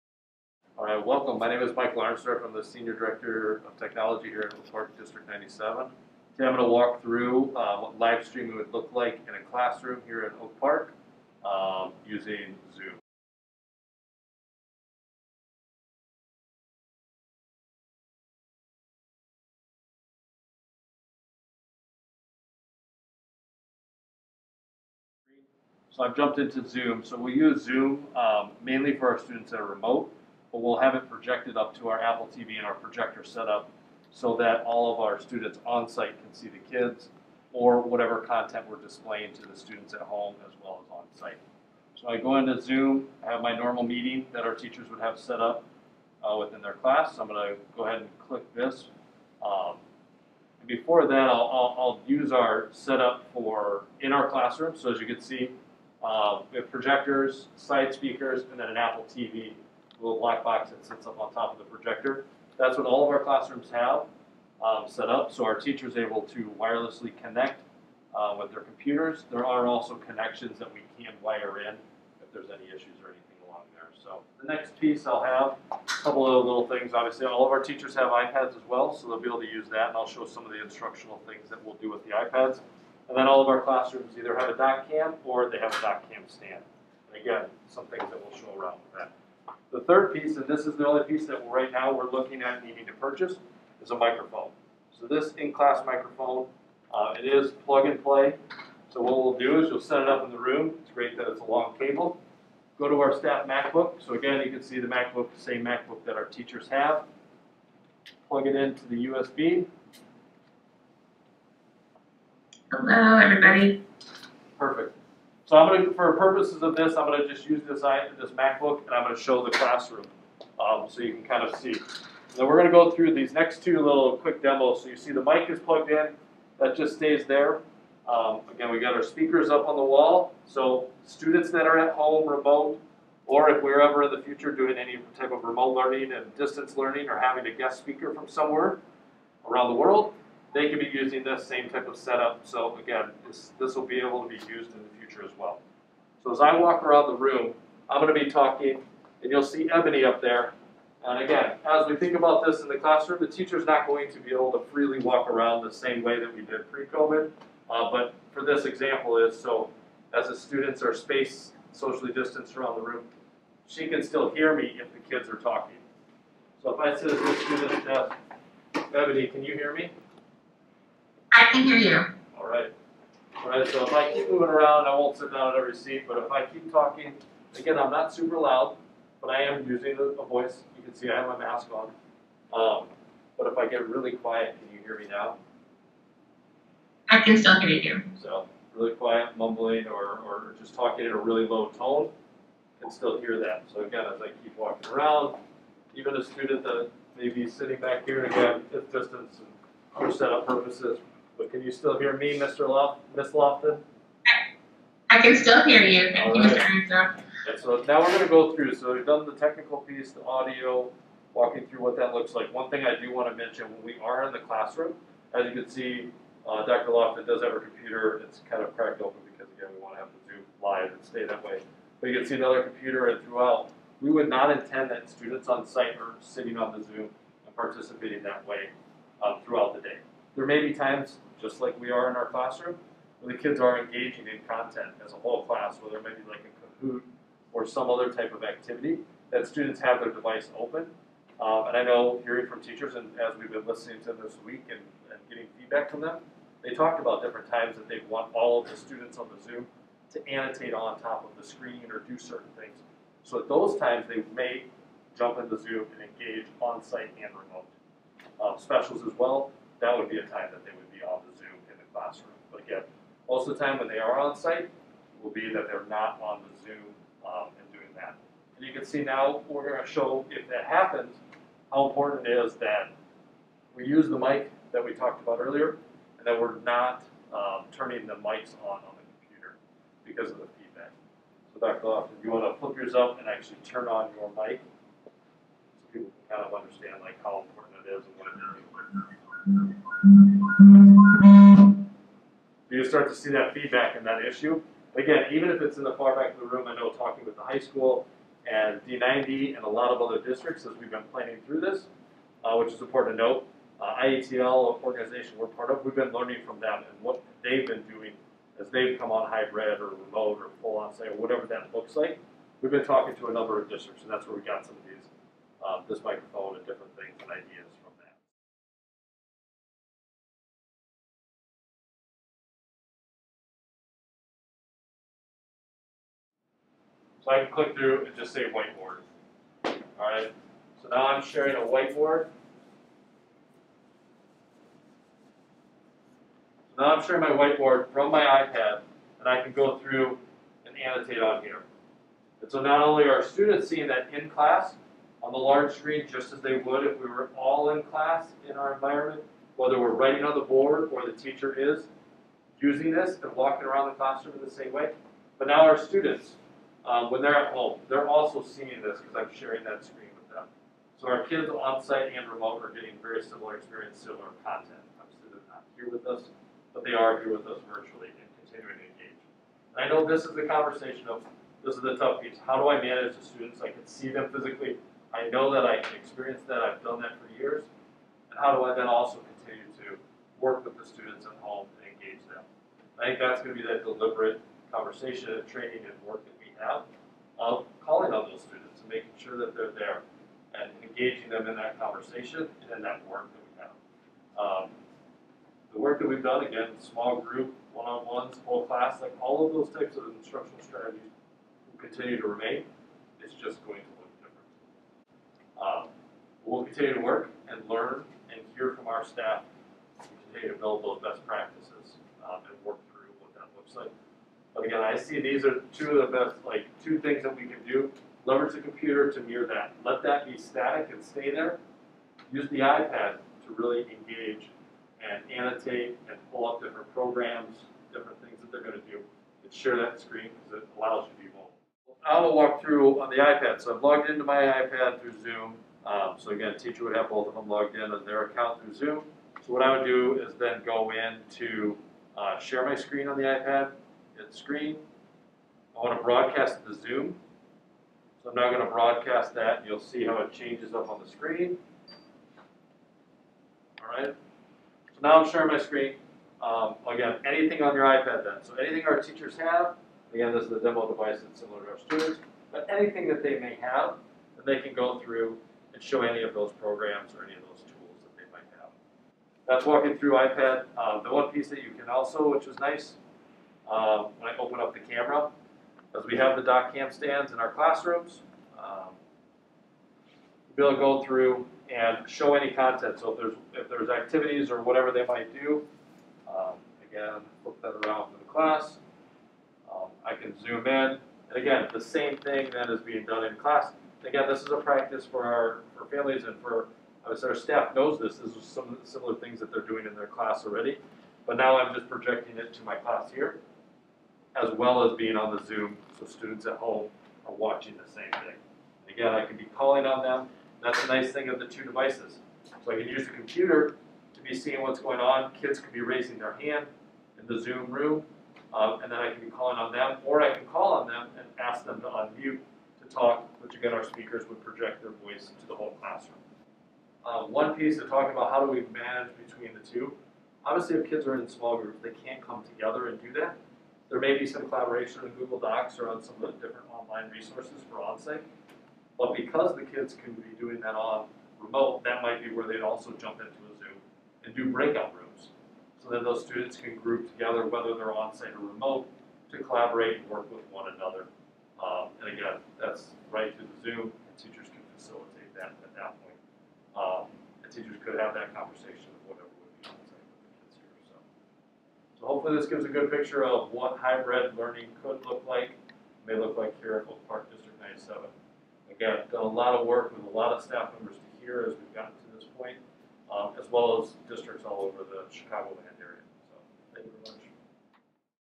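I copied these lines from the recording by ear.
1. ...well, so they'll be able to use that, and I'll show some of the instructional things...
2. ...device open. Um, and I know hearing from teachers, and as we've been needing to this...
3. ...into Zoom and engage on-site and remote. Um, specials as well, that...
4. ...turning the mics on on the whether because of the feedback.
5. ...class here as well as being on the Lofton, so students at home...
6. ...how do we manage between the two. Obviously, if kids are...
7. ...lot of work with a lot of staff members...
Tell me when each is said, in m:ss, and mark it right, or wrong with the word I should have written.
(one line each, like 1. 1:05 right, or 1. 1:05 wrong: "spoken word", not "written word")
1. 1:18 right
2. 4:00 wrong: "listening", not "needing"
3. 4:15 right
4. 4:37 wrong: "computer", not "whether"
5. 8:22 wrong: "Zoom", not "Lofton"
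6. 8:48 right
7. 9:29 right.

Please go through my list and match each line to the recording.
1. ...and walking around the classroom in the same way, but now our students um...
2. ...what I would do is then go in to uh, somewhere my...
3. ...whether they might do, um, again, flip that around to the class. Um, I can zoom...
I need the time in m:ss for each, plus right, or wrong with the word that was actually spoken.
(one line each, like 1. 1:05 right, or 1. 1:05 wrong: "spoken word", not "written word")
1. 5:53 right
2. 7:19 wrong: "share", not "somewhere"
3. 8:04 wrong: "whatever", not "whether".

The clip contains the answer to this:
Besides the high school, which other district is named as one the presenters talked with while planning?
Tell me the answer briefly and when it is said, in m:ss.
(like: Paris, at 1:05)
D90, at 4:58.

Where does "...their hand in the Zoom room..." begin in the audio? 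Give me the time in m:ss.
8:36.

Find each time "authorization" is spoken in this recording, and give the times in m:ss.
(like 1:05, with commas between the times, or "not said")
not said.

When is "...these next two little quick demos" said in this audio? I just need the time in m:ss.
2:03.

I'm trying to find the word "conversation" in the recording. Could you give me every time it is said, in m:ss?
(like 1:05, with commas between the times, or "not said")
6:10, 6:24, 6:31, 9:18.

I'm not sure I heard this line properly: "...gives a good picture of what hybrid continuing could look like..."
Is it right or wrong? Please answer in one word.
wrong.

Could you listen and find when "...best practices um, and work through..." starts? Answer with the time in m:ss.
6:51.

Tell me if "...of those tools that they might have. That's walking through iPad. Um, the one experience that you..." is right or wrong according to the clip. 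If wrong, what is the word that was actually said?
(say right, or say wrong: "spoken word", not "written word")
wrong: "piece", not "experience".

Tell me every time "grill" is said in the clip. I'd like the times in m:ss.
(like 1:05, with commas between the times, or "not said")
not said.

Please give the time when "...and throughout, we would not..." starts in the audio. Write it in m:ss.
3:43.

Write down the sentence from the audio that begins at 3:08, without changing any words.
So, really quiet, mumbling, or, or just talking in a really low tone, can still hear that.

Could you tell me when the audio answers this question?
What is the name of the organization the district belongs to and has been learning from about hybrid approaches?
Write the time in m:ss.
5:04.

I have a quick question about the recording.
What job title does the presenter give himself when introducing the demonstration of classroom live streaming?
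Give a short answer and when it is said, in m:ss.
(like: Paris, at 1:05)
Senior Director of Technology, at 0:02.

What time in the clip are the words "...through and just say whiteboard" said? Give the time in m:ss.
5:27.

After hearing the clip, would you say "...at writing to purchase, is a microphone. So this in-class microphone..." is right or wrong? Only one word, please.
wrong.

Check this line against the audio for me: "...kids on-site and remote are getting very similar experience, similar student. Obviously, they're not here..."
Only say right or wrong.
wrong.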